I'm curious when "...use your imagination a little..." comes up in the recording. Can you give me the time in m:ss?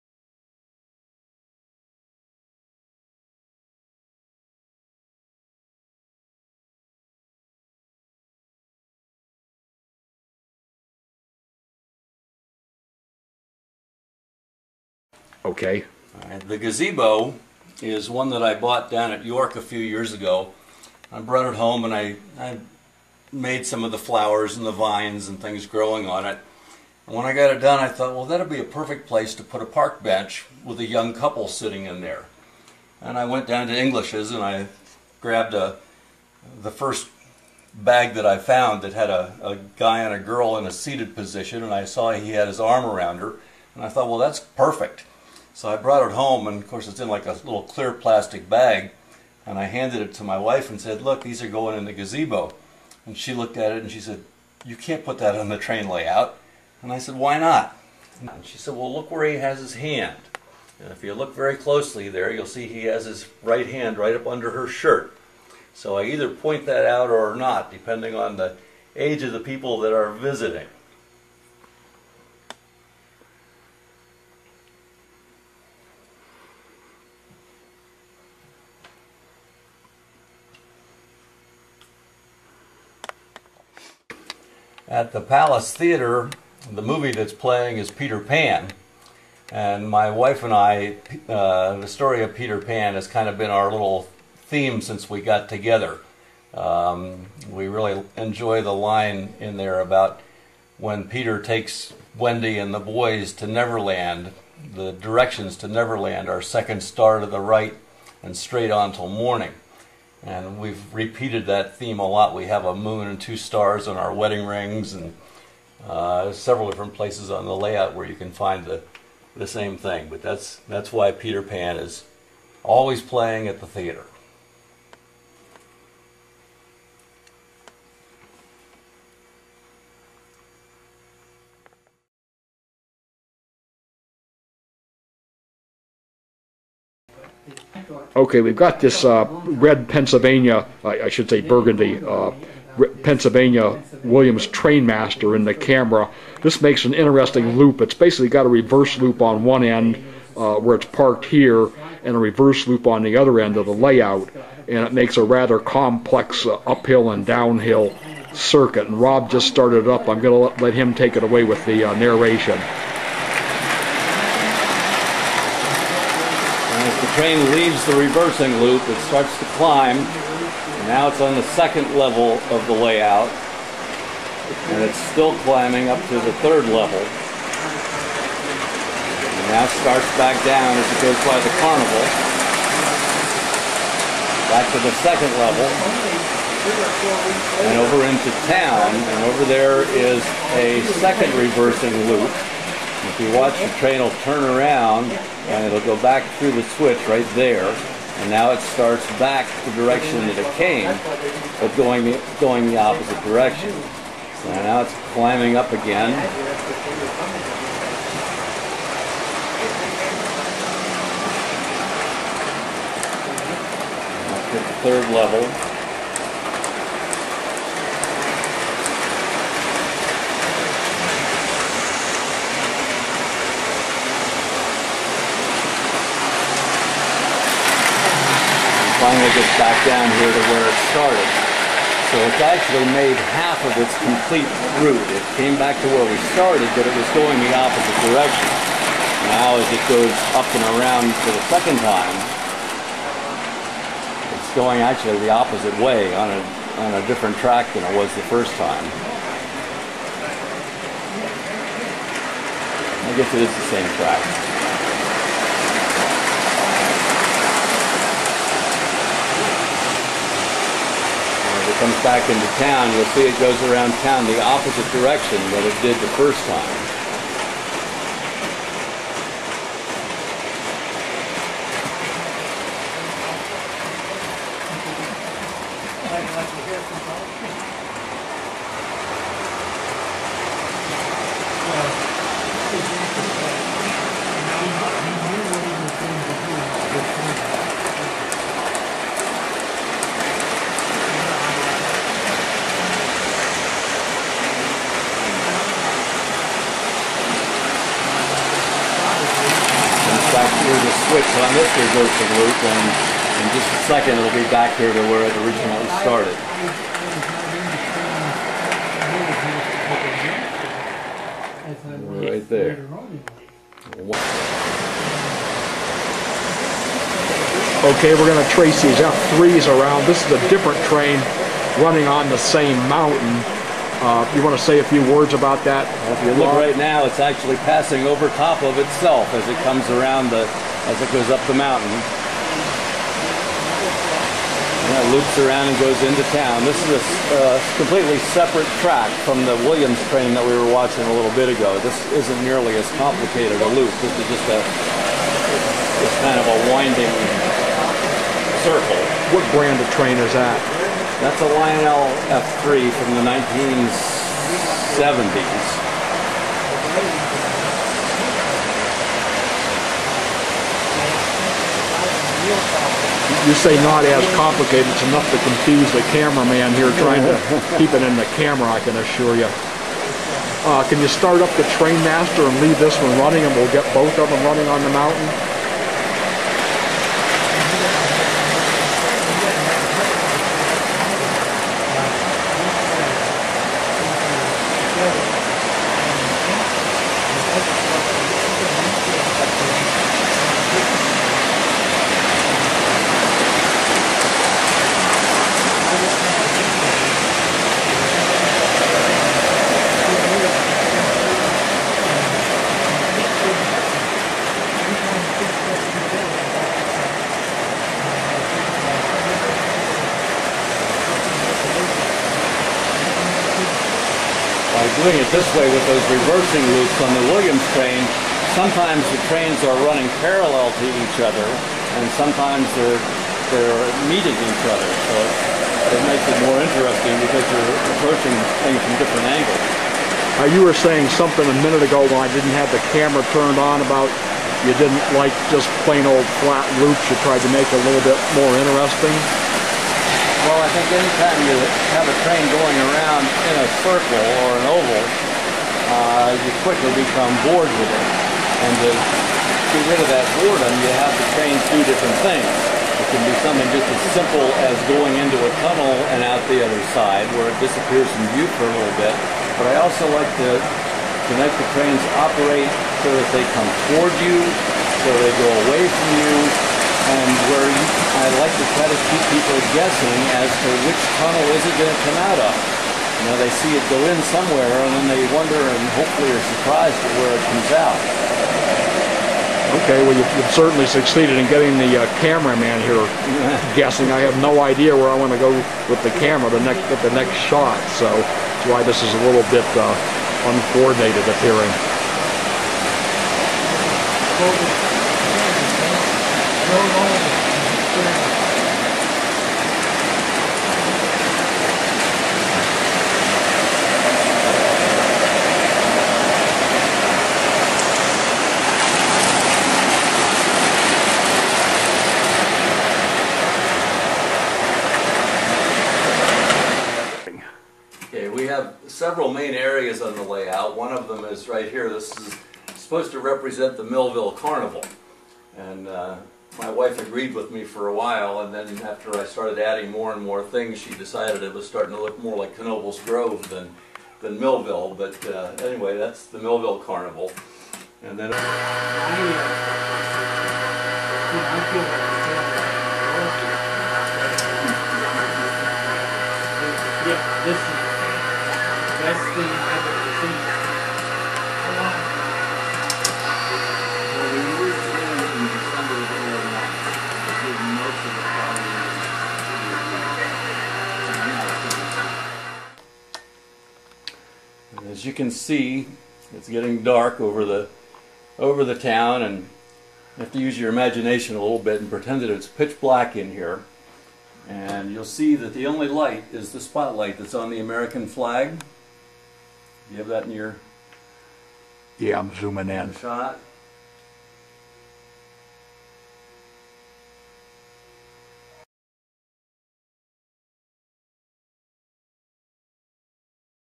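9:30.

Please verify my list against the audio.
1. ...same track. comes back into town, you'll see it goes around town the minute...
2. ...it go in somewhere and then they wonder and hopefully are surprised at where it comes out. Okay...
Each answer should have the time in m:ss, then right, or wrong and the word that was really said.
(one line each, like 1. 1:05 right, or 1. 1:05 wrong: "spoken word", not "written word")
1. 4:13 wrong: "opposite", not "minute"
2. 7:53 right.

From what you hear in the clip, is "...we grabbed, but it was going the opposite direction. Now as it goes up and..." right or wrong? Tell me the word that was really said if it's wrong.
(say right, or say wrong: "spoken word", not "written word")
wrong: "started", not "grabbed".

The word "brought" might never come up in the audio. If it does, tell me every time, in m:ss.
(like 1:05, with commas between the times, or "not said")
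0:21, 0:45.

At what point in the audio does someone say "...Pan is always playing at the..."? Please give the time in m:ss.
2:01.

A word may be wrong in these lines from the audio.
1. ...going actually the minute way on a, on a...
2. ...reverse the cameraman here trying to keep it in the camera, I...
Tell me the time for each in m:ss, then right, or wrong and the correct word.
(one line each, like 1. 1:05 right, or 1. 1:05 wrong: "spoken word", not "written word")
1. 4:04 wrong: "opposite", not "minute"
2. 6:05 wrong: "confuse", not "reverse".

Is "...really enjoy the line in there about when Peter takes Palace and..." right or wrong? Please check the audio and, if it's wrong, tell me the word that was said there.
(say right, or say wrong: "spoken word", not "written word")
wrong: "Wendy", not "Palace".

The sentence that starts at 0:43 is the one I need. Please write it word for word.
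And I thought, well, that's perfect.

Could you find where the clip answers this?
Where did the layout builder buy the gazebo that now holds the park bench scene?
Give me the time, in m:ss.
0:19.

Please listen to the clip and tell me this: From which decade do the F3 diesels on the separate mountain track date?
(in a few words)
1970s.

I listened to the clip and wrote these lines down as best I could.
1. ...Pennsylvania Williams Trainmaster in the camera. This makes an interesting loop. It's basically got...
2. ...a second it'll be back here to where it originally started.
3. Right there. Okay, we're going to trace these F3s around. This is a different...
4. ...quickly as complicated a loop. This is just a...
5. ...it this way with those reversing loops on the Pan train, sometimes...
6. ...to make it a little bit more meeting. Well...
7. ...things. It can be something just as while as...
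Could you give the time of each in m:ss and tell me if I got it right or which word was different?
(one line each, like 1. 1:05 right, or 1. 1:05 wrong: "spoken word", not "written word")
1. 2:23 right
2. 5:03 right
3. 5:12 right
4. 5:42 wrong: "nearly", not "quickly"
5. 6:55 wrong: "Williams", not "Pan"
6. 7:17 wrong: "interesting", not "meeting"
7. 7:32 wrong: "simple", not "while".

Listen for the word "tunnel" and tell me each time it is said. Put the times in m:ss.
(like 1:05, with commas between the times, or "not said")
7:35, 7:51.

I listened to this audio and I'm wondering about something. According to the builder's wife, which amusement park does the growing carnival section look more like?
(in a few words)
Knoebels Grove.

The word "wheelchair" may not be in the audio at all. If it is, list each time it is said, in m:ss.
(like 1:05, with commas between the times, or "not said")
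not said.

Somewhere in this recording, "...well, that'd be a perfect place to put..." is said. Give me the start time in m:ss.
0:28.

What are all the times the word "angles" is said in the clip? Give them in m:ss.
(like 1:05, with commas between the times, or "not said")
7:09.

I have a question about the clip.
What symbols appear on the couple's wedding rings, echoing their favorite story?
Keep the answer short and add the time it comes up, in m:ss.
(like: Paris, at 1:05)
A moon and two stars, at 1:52.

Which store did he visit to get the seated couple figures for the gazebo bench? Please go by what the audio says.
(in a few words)
English's.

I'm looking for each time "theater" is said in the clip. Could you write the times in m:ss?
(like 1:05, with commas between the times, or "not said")
1:25, 2:03.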